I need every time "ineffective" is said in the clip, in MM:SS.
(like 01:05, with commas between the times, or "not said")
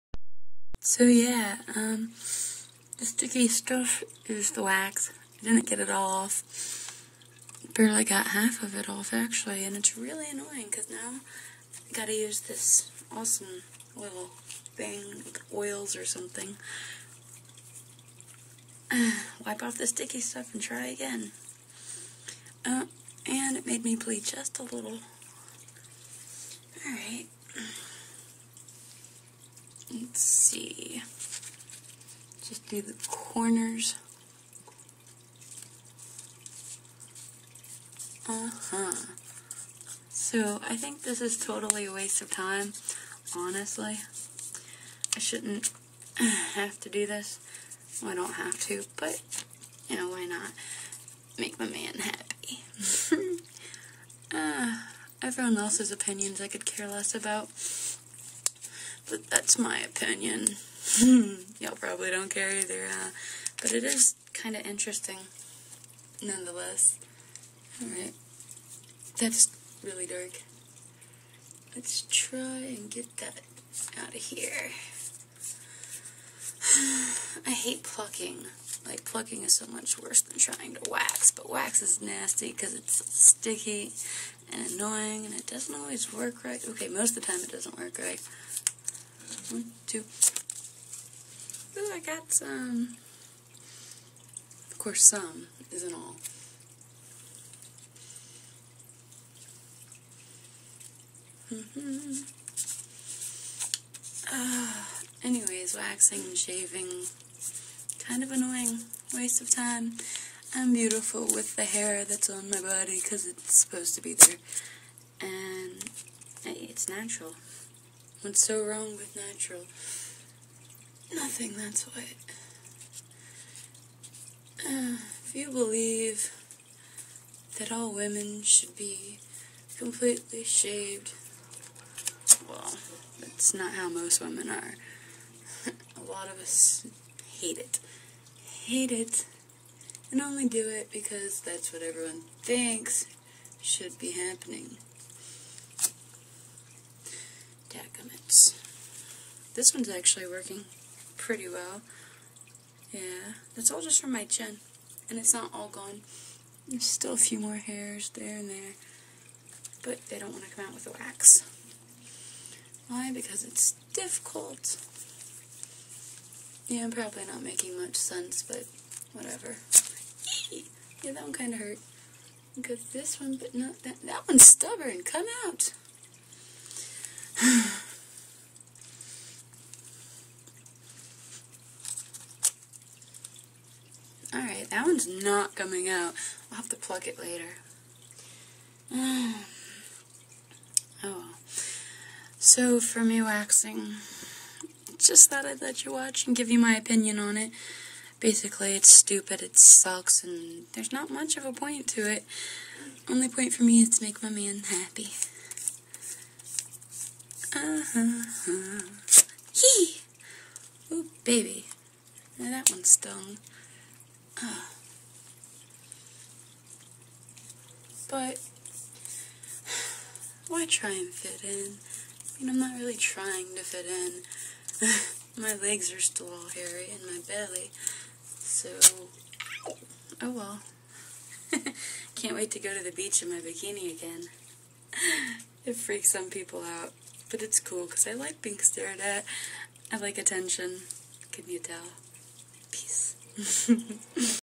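not said.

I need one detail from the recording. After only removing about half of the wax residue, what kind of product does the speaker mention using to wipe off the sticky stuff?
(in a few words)
oils.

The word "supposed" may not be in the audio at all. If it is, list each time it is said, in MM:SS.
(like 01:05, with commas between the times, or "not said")
01:53.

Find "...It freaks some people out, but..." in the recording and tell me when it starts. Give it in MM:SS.
03:55.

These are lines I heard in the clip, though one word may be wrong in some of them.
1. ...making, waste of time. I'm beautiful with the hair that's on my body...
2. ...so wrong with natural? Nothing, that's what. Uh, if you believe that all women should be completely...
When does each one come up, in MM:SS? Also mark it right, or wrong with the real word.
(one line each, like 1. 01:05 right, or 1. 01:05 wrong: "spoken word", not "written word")
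1. 01:48 wrong: "annoying", not "making"
2. 01:58 right.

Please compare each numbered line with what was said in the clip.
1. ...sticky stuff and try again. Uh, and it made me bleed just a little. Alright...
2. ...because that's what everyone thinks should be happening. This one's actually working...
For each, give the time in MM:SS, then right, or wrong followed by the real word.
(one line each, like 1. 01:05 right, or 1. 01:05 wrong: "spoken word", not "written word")
1. 00:19 right
2. 02:20 right.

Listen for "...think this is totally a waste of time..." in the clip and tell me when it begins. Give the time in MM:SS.
00:40.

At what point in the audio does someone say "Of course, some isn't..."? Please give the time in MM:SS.
01:34.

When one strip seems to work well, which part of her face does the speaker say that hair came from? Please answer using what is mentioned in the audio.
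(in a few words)
chin.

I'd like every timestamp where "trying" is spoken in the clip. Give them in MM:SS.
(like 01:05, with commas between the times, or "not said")
01:20, 03:42.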